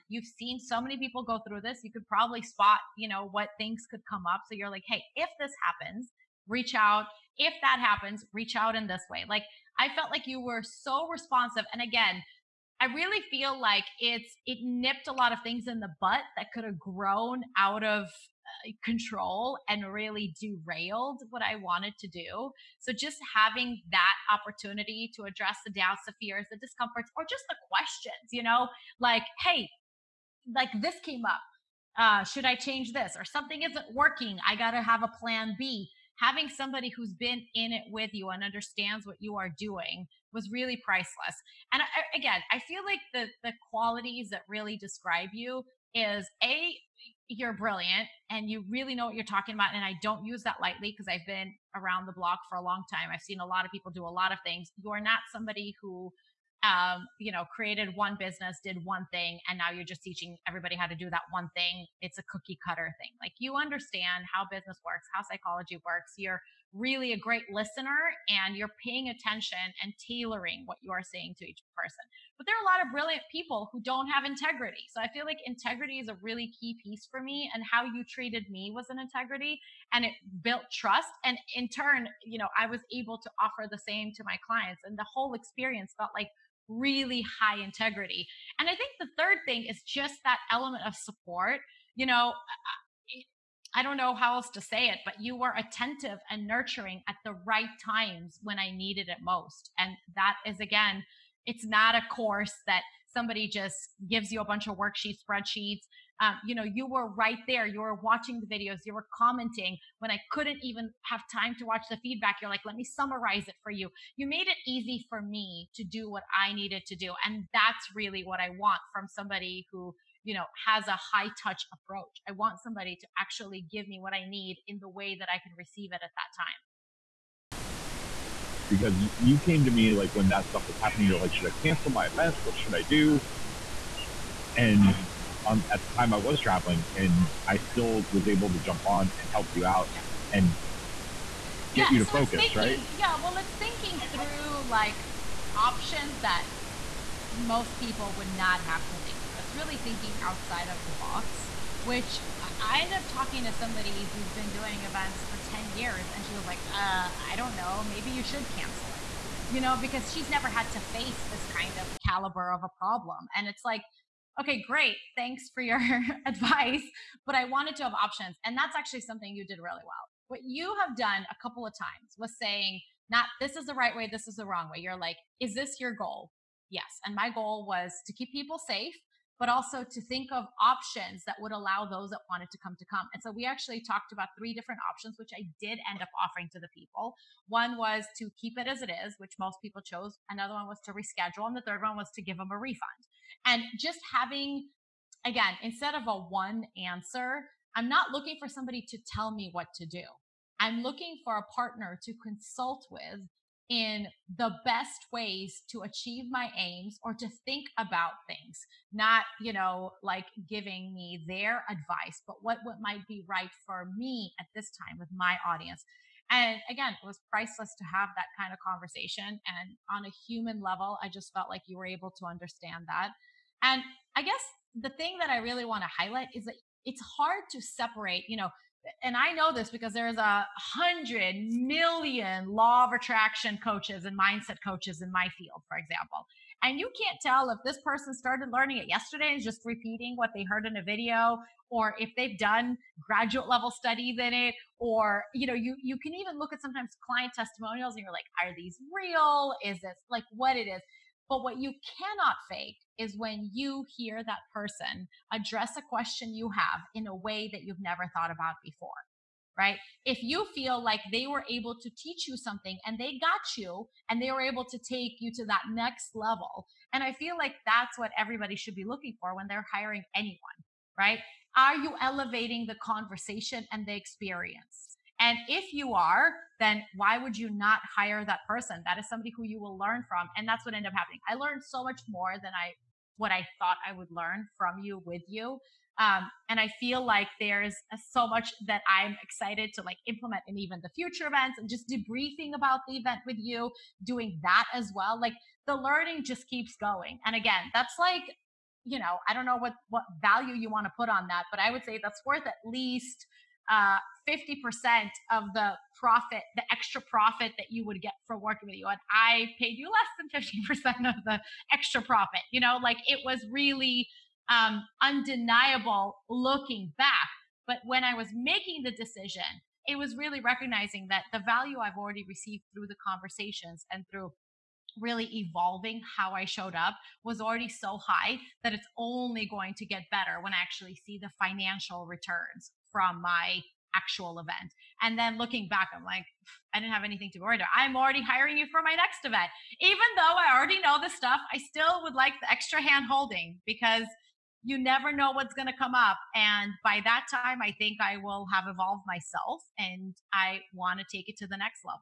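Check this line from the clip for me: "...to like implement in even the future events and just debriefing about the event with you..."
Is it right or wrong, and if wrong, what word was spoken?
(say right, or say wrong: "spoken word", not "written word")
right.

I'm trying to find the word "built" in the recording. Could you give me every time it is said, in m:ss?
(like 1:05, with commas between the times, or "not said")
1:20.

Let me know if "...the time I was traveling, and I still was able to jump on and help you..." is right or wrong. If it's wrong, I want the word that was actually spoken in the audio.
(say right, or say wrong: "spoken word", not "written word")
right.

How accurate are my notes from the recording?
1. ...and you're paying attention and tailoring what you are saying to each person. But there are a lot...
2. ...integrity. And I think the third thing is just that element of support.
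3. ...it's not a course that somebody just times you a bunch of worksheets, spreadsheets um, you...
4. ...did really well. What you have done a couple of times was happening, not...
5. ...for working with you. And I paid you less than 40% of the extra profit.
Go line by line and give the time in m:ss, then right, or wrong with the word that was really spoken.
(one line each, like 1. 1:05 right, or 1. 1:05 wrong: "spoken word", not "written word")
1. 1:08 right
2. 1:27 right
3. 1:41 wrong: "gives", not "times"
4. 2:49 wrong: "saying", not "happening"
5. 5:08 wrong: "50", not "40".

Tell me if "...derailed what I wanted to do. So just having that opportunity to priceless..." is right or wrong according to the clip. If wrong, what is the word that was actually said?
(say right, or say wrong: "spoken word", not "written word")
wrong: "address", not "priceless".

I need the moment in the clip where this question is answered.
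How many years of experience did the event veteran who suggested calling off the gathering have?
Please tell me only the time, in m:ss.
2:35.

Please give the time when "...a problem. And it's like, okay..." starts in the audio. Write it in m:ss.
2:42.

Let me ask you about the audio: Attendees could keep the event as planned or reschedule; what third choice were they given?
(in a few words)
A refund.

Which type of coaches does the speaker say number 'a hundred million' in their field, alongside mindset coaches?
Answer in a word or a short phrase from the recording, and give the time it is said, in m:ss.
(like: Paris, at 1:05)
Law of attraction coaches, at 3:52.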